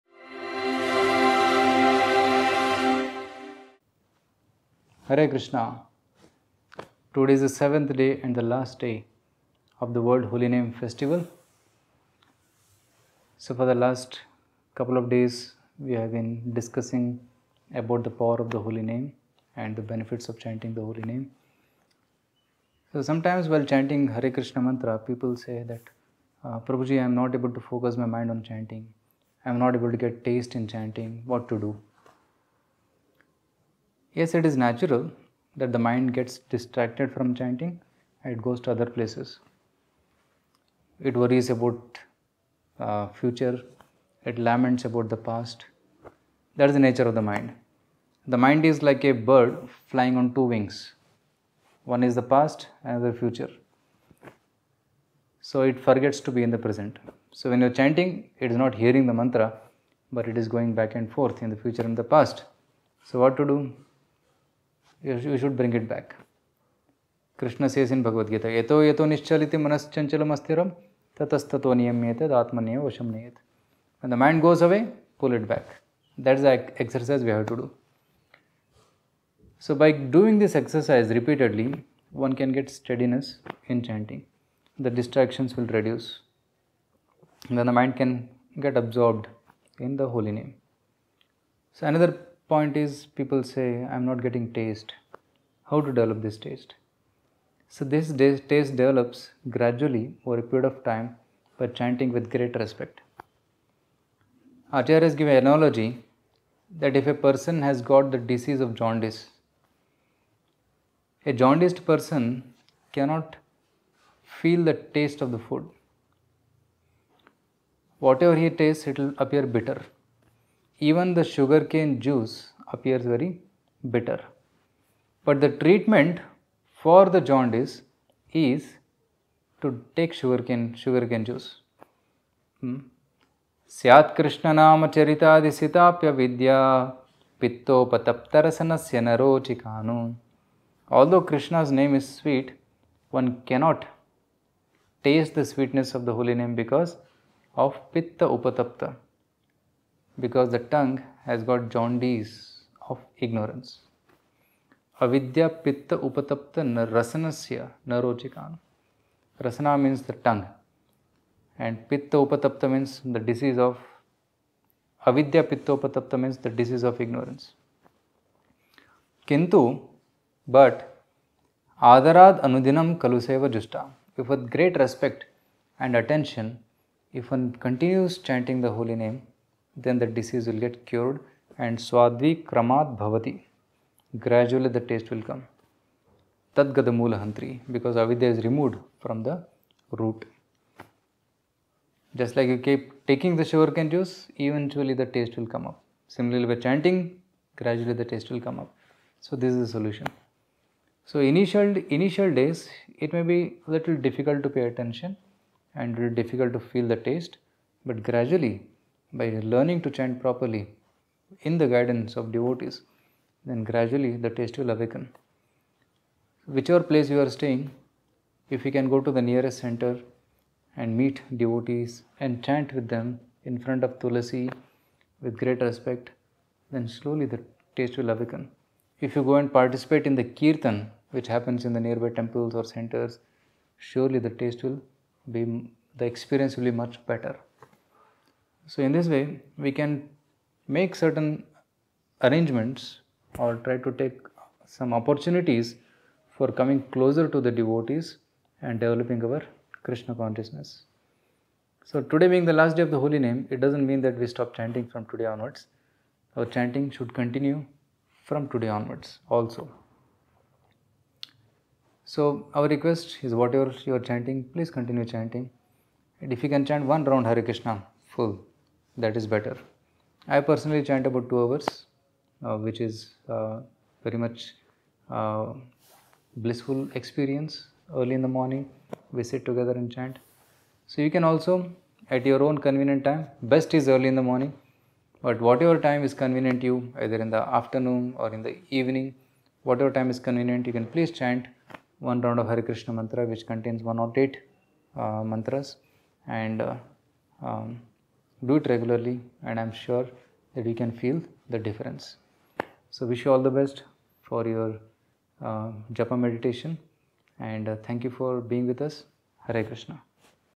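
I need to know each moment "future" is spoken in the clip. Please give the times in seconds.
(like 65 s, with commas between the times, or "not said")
43 s, 53 s, 61 s.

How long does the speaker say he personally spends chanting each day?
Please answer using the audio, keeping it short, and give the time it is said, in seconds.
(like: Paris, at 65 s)
About 2 hours, at 271 s.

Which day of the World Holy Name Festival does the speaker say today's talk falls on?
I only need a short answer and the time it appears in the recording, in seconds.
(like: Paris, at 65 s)
Seventh day, at 7 s.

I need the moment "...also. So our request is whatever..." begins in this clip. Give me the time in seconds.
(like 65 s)
259 s.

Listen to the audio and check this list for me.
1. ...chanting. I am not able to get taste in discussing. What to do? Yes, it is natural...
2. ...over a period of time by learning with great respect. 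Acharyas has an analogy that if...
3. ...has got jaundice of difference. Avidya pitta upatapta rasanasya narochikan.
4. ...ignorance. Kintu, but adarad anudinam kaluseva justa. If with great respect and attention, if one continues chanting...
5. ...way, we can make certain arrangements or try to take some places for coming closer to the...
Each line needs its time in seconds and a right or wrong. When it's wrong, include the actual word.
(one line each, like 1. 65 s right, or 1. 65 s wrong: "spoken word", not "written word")
1. 28 s wrong: "chanting", not "discussing"
2. 100 s wrong: "chanting", not "learning"
3. 151 s wrong: "ignorance", not "difference"
4. 167 s right
5. 239 s wrong: "opportunities", not "places".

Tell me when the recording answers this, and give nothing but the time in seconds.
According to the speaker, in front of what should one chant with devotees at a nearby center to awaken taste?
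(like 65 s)
223 s.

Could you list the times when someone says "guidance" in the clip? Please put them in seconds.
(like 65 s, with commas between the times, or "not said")
211 s.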